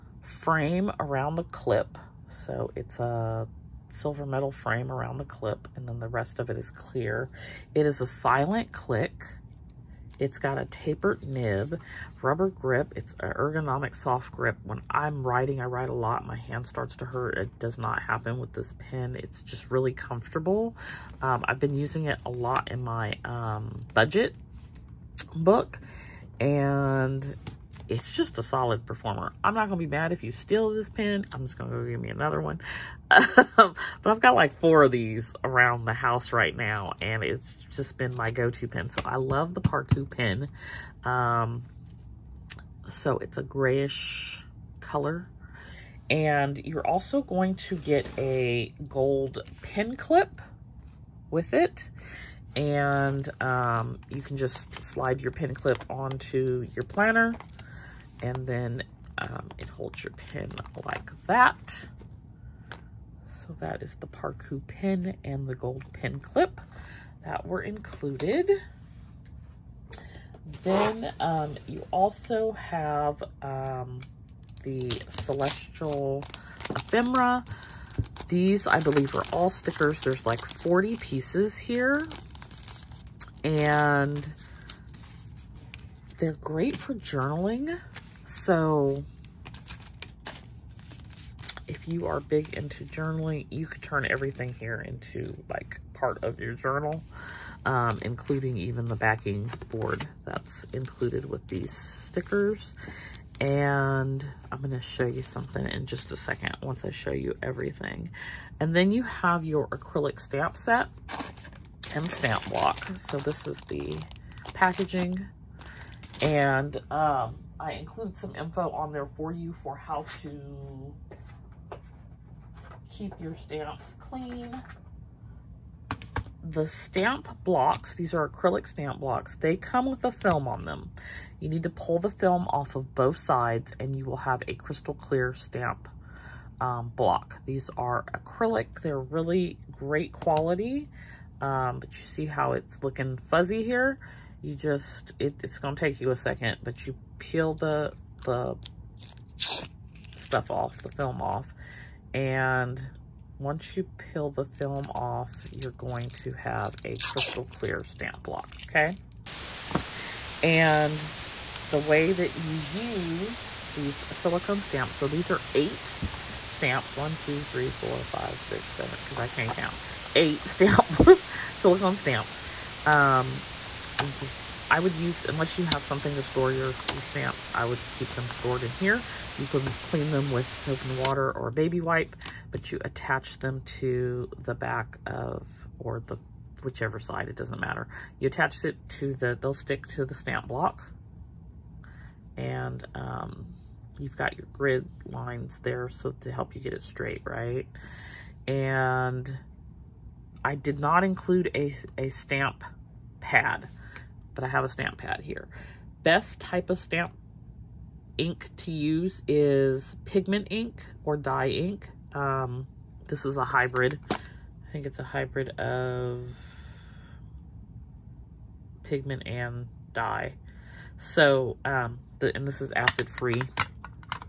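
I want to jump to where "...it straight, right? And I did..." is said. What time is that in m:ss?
3:16.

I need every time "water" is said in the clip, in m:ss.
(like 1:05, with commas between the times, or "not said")
3:00.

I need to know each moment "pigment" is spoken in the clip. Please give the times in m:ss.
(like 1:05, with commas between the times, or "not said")
3:30, 3:38.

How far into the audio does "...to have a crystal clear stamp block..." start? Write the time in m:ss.
2:36.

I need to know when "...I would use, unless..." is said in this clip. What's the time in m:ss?
2:54.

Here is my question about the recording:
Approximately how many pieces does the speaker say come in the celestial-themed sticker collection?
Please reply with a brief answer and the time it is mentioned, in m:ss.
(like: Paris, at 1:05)
40, at 1:20.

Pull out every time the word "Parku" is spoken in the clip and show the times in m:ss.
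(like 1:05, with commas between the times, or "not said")
0:39, 1:04.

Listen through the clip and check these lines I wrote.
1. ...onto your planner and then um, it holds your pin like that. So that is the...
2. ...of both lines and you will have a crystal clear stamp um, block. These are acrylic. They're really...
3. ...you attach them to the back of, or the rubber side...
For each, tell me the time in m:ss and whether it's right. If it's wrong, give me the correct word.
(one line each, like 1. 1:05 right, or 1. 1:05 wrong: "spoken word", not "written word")
1. 0:55 right
2. 2:12 wrong: "sides", not "lines"
3. 3:02 wrong: "whichever", not "rubber".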